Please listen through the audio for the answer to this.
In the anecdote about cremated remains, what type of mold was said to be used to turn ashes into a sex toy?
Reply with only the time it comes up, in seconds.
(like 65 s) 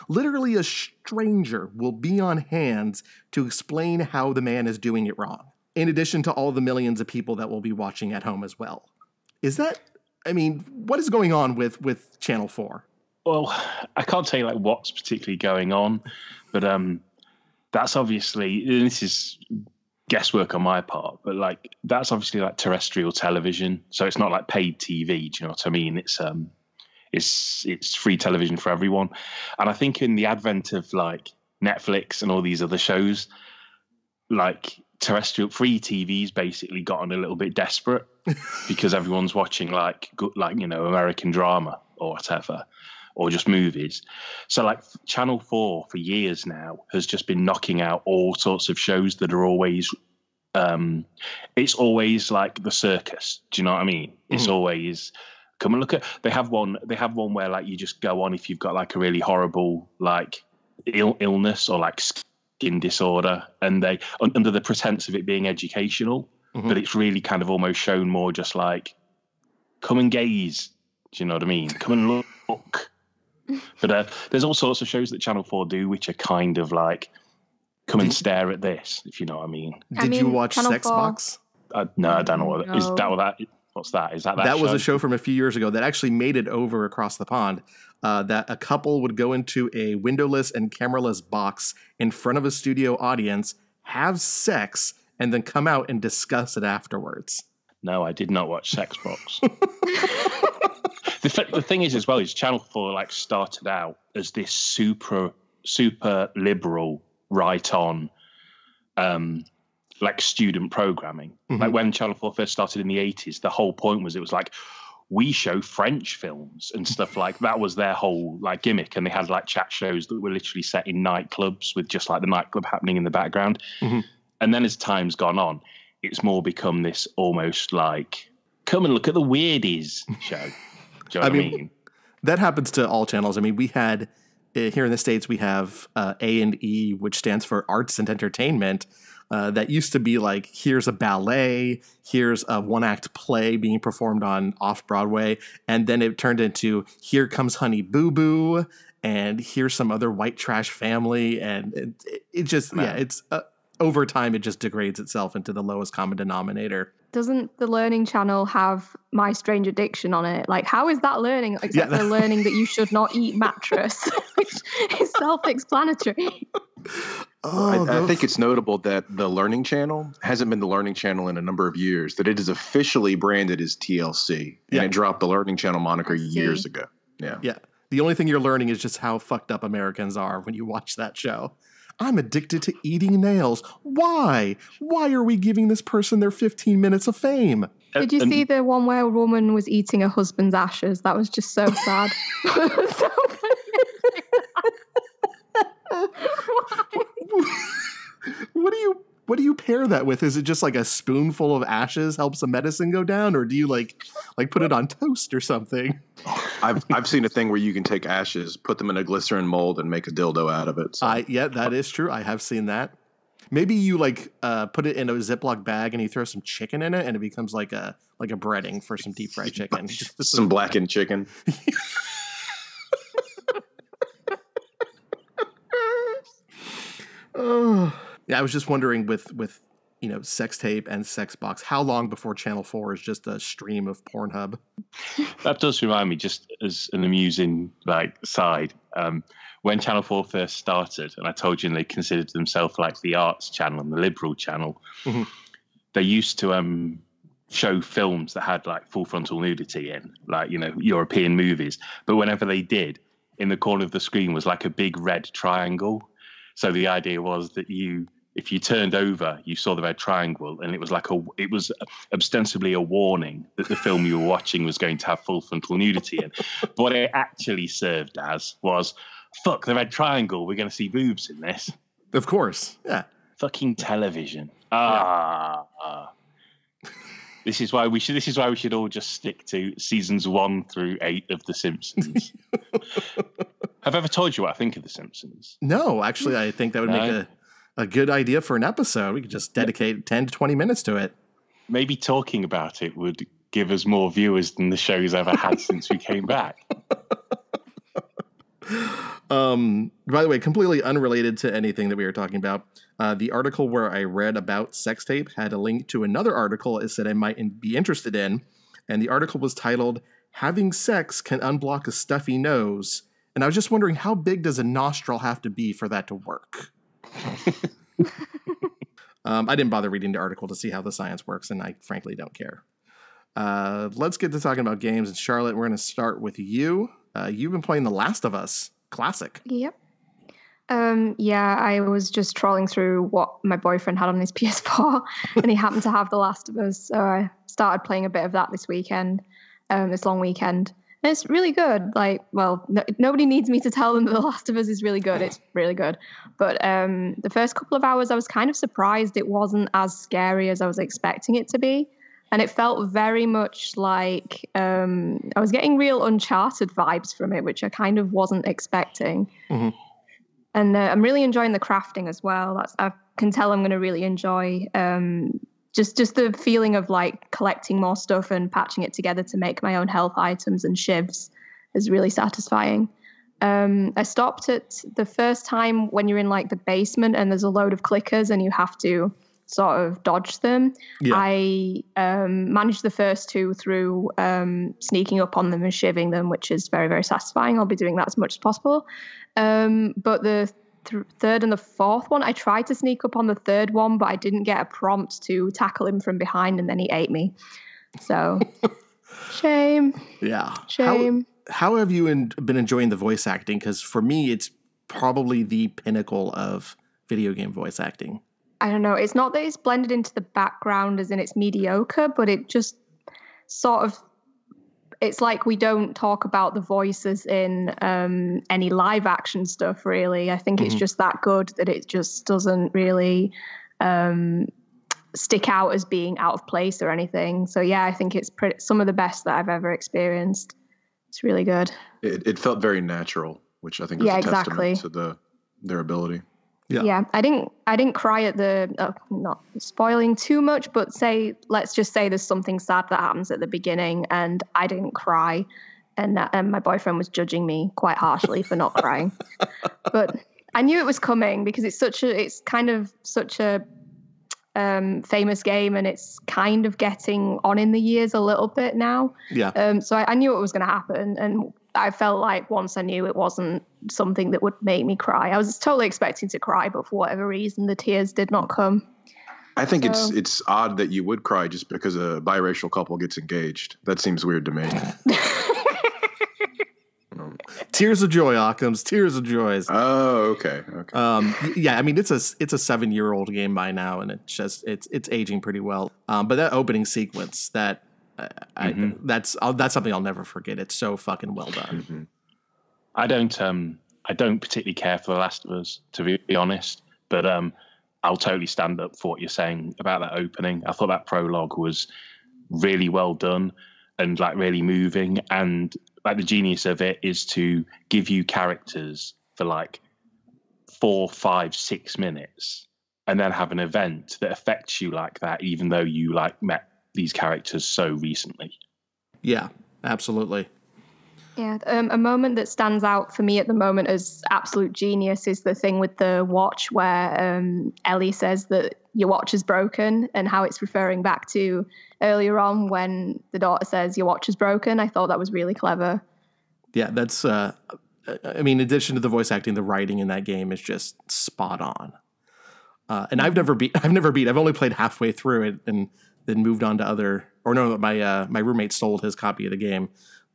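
209 s.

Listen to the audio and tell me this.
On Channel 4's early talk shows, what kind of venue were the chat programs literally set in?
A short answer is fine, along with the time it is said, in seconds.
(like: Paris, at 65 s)
Nightclubs, at 121 s.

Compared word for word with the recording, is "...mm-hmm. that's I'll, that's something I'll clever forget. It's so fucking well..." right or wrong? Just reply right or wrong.
wrong.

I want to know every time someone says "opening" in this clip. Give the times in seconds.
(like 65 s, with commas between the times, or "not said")
486 s, 500 s.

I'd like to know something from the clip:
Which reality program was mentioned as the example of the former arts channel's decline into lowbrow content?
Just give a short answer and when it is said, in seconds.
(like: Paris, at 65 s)
Honey Boo Boo, at 147 s.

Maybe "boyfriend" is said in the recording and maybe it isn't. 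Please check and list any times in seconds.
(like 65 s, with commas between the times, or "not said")
333 s, 446 s.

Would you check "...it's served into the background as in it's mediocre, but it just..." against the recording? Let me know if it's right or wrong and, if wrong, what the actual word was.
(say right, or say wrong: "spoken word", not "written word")
wrong: "blended", not "served".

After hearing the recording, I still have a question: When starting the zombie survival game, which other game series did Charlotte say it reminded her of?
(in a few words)
Uncharted.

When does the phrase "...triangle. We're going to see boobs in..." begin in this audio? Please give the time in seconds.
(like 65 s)
269 s.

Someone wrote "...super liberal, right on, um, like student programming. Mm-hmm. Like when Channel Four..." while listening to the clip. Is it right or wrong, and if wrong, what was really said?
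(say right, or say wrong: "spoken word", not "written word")
right.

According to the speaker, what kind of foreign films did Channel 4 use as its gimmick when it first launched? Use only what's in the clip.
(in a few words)
French films.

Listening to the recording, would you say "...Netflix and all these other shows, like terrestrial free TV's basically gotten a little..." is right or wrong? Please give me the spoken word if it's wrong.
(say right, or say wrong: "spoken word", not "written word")
right.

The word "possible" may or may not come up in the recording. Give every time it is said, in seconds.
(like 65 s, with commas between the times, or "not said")
388 s.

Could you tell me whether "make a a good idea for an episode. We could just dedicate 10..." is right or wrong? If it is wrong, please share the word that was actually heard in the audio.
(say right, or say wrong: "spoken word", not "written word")
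right.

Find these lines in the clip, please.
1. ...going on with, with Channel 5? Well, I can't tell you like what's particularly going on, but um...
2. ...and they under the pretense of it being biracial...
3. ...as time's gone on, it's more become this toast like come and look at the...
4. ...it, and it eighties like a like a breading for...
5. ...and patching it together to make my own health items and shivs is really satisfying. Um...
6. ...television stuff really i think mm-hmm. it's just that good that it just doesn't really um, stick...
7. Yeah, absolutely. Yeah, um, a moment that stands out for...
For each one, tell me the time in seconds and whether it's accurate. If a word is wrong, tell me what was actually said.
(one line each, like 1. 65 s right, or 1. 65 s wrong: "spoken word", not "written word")
1. 11 s wrong: "4", not "5"
2. 63 s wrong: "educational", not "biracial"
3. 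124 s wrong: "almost", not "toast"
4. 216 s wrong: "becomes", not "eighties"
5. 368 s right
6. 419 s wrong: "action", not "television"
7. 519 s right.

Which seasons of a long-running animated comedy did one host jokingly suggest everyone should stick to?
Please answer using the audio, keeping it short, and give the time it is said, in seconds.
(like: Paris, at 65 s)
1 through 8, at 280 s.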